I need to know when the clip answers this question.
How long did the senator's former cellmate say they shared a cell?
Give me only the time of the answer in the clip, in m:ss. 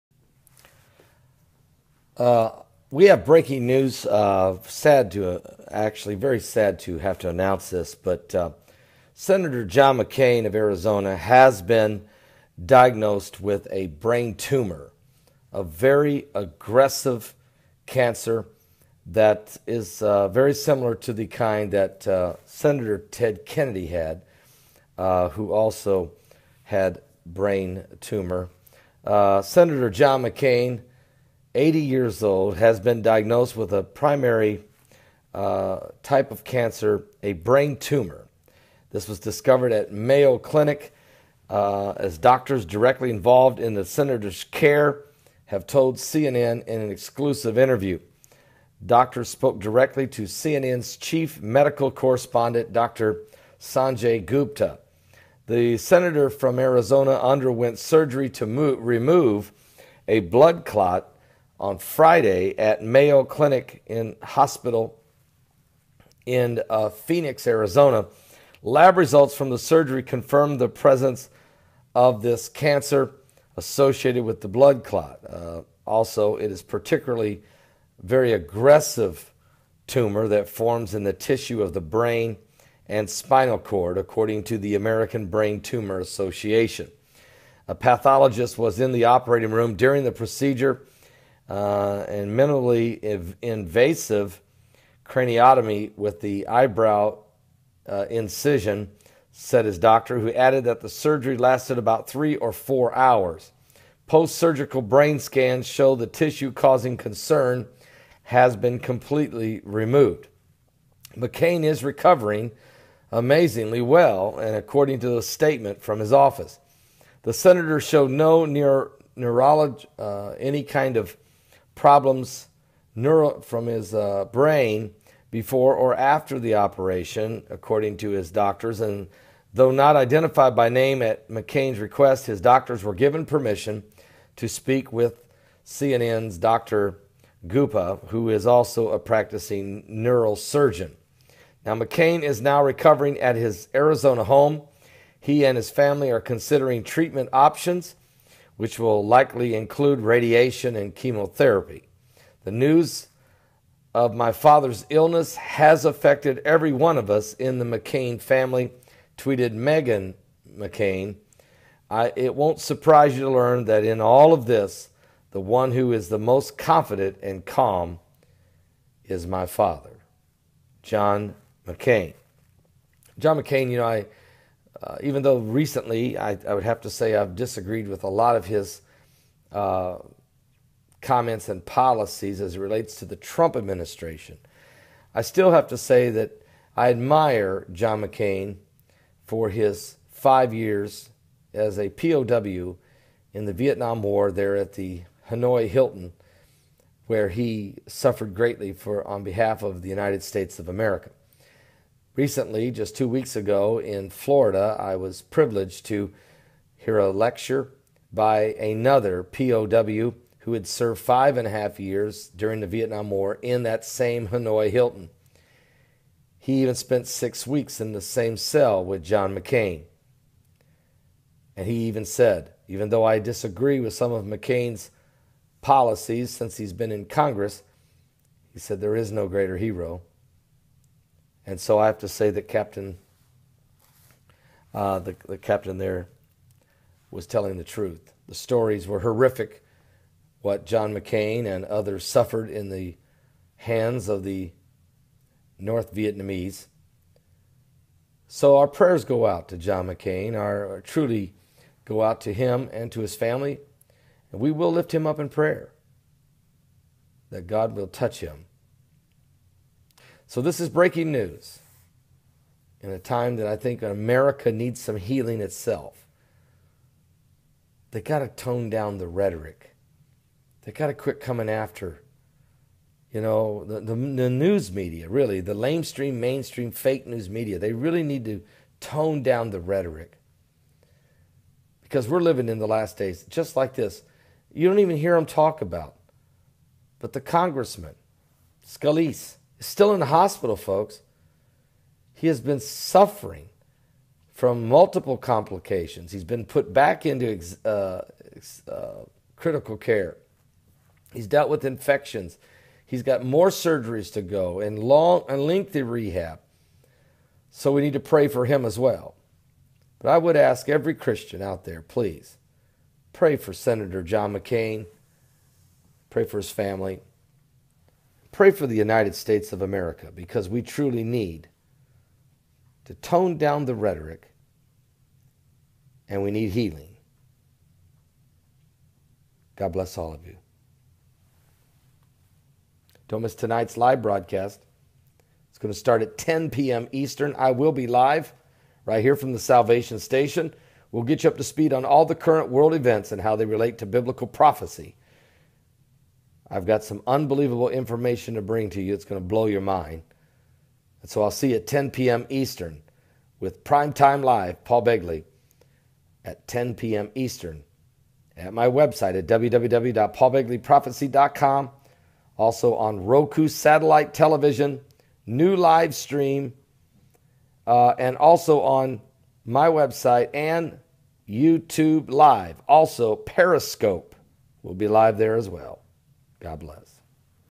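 3:37.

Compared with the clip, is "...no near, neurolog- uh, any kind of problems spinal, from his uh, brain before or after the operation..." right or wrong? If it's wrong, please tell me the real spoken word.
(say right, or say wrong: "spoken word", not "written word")
wrong: "neural", not "spinal".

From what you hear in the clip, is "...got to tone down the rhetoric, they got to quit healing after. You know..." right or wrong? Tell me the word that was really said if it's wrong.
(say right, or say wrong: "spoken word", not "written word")
wrong: "coming", not "healing".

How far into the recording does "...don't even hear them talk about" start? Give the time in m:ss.
4:44.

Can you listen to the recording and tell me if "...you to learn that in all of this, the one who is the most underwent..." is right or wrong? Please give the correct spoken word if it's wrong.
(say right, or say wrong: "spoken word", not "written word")
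wrong: "confident", not "underwent".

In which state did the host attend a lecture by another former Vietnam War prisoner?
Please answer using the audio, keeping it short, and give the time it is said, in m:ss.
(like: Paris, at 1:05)
Florida, at 3:24.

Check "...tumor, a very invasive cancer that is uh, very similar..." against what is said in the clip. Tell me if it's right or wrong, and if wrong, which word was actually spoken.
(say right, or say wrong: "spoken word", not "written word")
wrong: "aggressive", not "invasive".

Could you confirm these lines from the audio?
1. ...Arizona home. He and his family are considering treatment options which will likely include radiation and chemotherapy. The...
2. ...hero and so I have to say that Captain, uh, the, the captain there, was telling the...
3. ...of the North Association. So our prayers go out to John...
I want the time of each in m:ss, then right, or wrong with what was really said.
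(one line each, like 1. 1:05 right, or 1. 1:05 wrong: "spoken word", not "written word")
1. 2:23 right
2. 3:49 right
3. 4:04 wrong: "Vietnamese", not "Association".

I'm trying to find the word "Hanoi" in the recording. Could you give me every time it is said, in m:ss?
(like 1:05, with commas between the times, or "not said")
3:15, 3:34.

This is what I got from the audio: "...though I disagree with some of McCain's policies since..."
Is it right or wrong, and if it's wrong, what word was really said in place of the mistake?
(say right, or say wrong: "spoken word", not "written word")
right.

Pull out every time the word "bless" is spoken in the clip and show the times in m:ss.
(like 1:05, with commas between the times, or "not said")
5:29, 6:16.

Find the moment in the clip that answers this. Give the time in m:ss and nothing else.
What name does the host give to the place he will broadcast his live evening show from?
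5:39.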